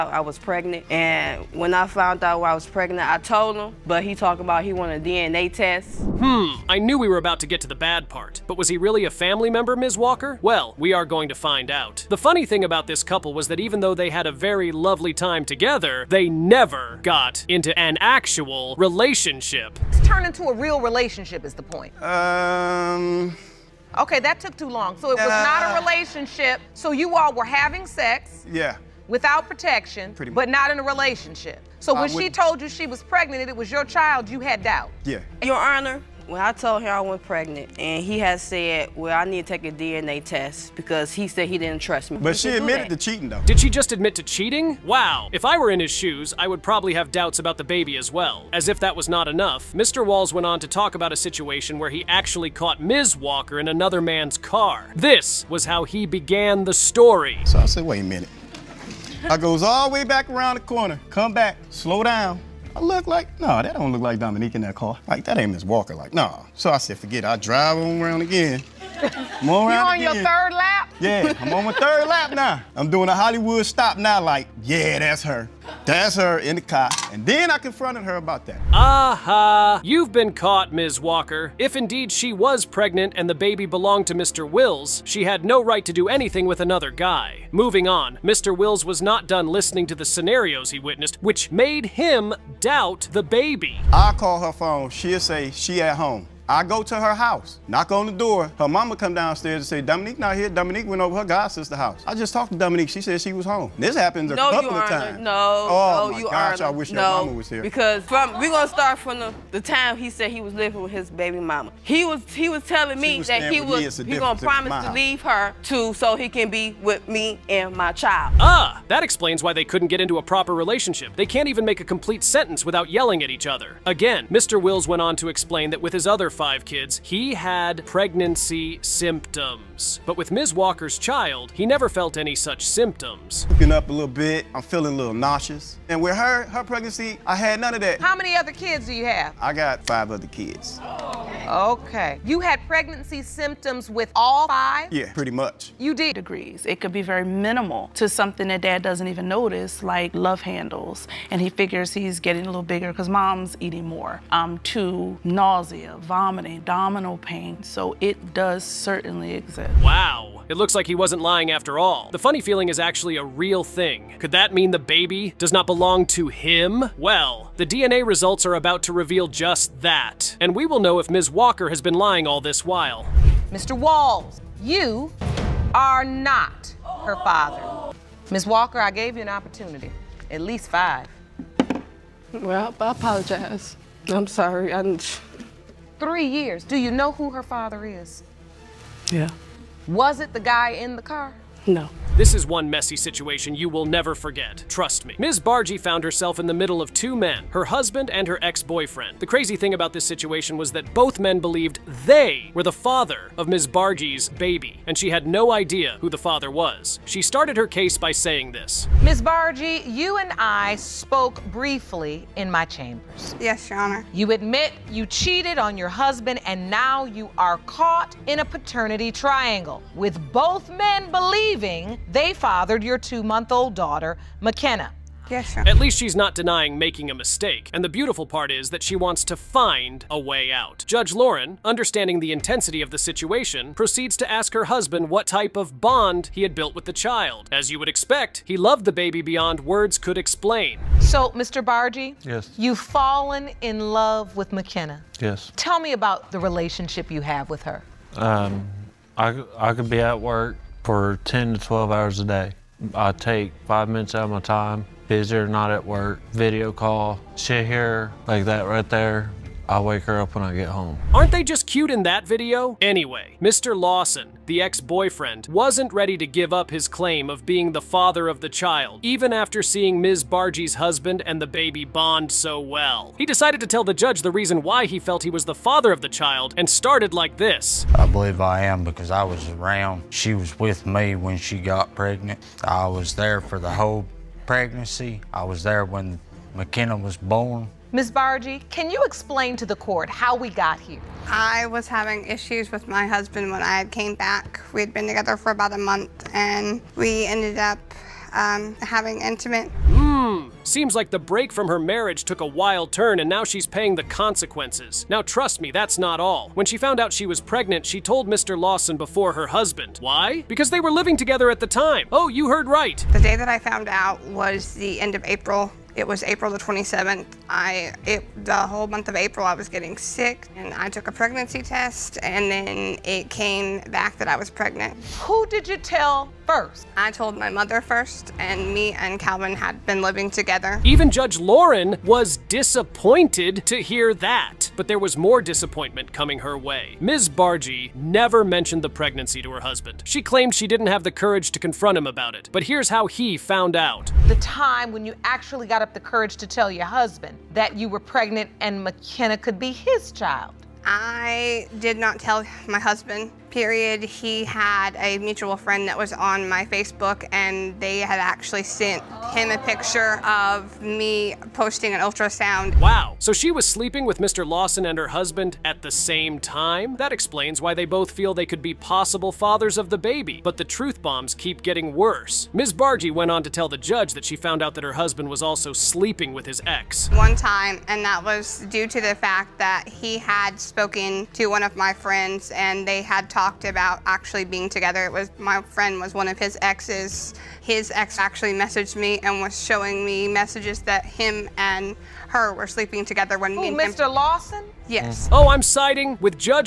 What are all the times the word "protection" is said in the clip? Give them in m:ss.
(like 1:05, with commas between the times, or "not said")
0:29.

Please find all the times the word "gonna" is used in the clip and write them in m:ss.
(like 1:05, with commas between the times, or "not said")
1:48, 1:54.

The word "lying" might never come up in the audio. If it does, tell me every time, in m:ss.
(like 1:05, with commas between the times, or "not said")
2:41, 2:51.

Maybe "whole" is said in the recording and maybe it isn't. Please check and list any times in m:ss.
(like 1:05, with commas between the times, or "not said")
4:43, 5:18.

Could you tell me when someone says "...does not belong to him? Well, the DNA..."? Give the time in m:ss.
2:45.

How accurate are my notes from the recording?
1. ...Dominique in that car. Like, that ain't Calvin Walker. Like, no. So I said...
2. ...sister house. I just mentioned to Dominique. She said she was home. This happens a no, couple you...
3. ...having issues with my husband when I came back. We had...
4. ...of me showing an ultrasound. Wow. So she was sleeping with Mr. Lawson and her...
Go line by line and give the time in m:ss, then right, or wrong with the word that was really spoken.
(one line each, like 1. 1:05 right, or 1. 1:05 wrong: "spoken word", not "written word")
1. 1:04 wrong: "Miss", not "Calvin"
2. 1:41 wrong: "talked", not "mentioned"
3. 4:51 right
4. 6:00 wrong: "posting", not "showing".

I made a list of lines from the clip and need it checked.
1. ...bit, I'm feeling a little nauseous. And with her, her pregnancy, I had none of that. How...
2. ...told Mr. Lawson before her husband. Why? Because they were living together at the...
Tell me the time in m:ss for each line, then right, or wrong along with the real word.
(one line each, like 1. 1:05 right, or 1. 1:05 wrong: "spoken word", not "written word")
1. 2:14 right
2. 5:07 right.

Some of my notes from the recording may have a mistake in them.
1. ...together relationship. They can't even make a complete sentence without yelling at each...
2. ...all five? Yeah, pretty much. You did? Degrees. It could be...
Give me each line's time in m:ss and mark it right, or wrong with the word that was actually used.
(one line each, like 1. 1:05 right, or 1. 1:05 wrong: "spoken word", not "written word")
1. 2:00 wrong: "proper", not "together"
2. 2:24 right.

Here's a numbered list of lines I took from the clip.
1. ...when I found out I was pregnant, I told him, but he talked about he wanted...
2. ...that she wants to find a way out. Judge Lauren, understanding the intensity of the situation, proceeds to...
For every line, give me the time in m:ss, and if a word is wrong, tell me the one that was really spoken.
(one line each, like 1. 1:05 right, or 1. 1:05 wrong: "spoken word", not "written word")
1. 0:01 right
2. 3:48 right.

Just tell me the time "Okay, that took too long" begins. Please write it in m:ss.
0:23.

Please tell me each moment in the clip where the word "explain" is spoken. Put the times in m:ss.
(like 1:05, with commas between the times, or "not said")
1:59, 2:05, 4:00, 4:49, 6:07.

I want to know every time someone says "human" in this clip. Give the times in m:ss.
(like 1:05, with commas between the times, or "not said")
not said.